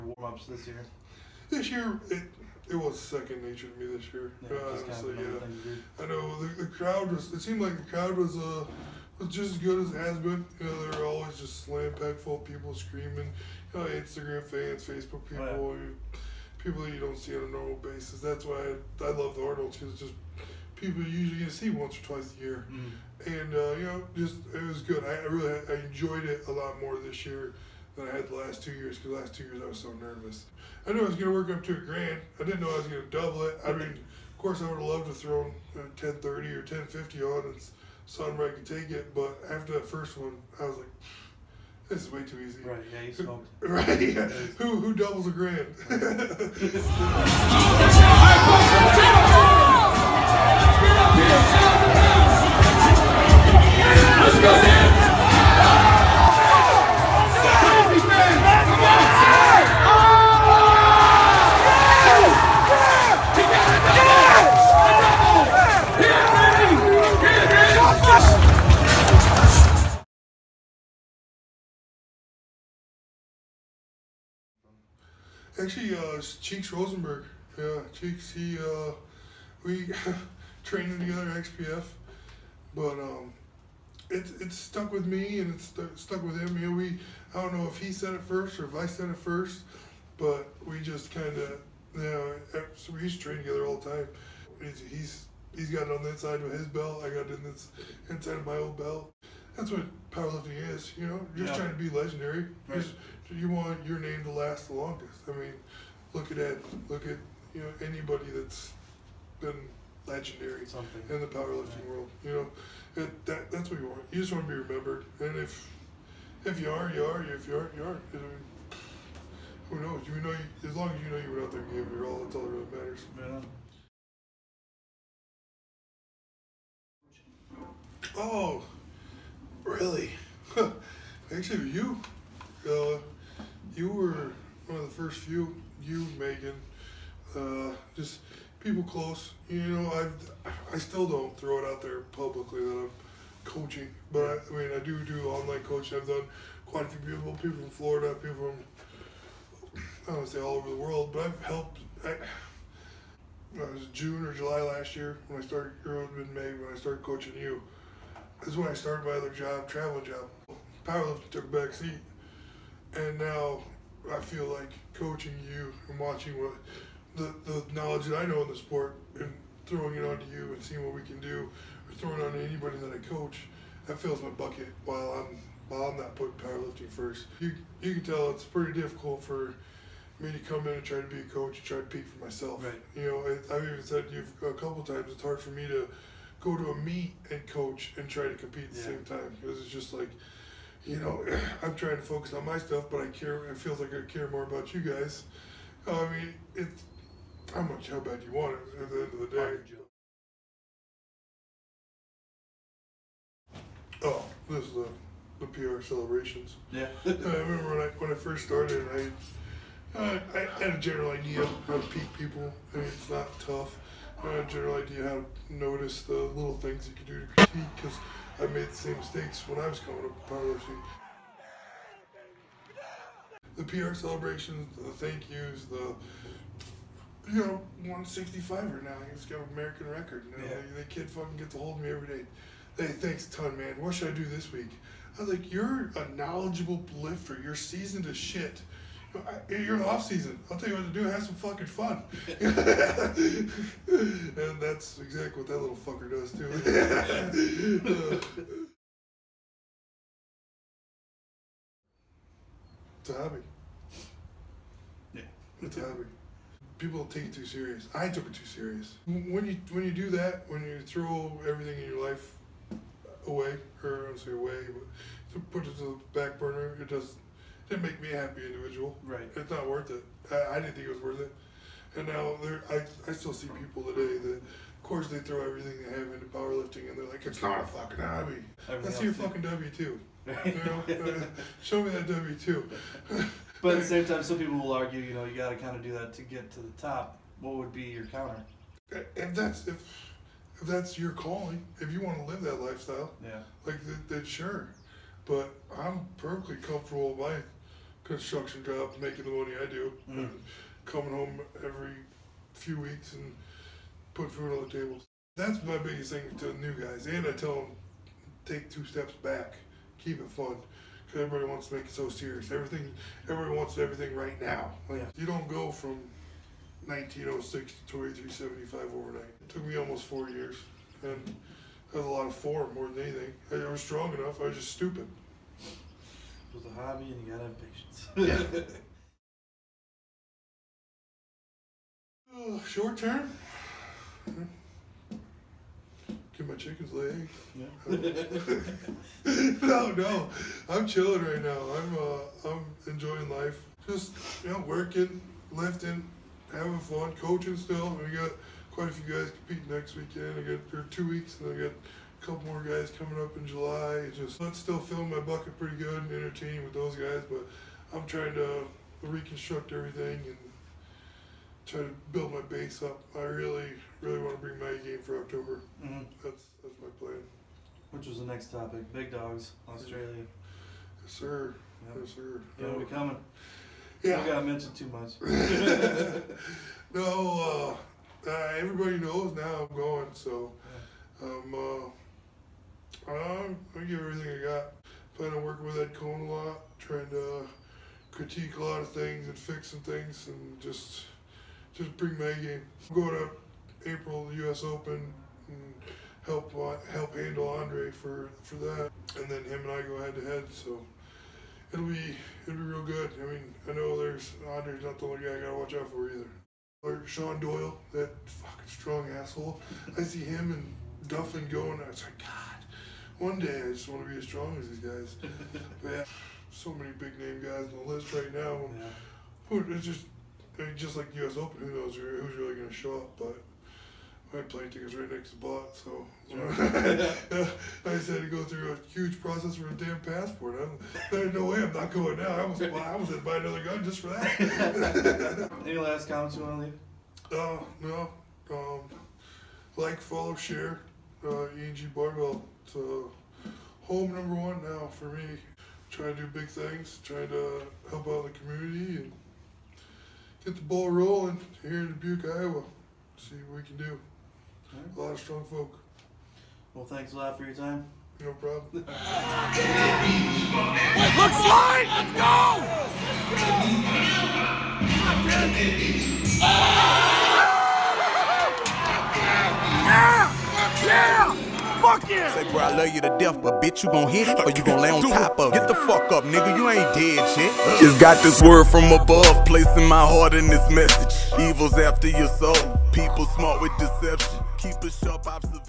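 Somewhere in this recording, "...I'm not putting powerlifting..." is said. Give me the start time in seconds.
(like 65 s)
175 s.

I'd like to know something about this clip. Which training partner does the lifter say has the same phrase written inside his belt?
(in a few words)
Cheeks Rosenberg.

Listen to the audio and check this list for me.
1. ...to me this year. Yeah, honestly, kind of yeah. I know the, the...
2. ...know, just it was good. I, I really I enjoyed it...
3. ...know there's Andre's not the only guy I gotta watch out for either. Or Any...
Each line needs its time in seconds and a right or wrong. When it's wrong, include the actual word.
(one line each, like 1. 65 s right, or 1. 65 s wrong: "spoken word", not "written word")
1. 3 s right
2. 23 s right
3. 403 s wrong: "Sean", not "Any".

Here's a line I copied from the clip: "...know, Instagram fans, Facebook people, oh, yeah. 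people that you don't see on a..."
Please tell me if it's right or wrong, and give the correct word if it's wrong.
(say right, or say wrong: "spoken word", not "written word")
right.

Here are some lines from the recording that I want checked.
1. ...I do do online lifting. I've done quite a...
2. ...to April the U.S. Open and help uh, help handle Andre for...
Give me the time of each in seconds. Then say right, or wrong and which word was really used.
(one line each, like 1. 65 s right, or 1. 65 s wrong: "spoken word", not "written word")
1. 144 s wrong: "coaching", not "lifting"
2. 393 s right.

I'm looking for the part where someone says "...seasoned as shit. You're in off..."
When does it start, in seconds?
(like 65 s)
237 s.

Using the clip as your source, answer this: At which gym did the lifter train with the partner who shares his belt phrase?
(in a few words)
XPF.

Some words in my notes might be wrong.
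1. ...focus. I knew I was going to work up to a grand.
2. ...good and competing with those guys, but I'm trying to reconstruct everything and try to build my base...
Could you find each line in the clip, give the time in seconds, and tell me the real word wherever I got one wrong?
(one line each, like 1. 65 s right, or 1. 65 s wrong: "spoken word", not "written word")
1. 29 s wrong: "nervous", not "focus"
2. 355 s wrong: "entertaining", not "competing".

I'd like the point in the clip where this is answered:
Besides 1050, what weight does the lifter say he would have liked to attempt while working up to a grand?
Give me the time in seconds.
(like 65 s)
35 s.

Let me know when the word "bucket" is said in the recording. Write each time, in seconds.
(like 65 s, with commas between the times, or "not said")
174 s, 355 s.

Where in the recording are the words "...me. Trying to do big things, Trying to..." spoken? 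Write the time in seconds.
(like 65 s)
445 s.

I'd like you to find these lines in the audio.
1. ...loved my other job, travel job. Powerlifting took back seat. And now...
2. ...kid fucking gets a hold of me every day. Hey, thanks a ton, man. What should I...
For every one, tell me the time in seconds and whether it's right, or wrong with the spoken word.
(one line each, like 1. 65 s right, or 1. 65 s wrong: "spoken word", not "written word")
1. 158 s wrong: "started", not "loved"
2. 230 s right.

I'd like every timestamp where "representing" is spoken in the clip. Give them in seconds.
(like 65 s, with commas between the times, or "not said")
not said.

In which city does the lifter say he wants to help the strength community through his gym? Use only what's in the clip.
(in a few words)
Dubuque, Iowa.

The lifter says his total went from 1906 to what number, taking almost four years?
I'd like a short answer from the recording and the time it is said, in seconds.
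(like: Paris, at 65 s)
2375, at 317 s.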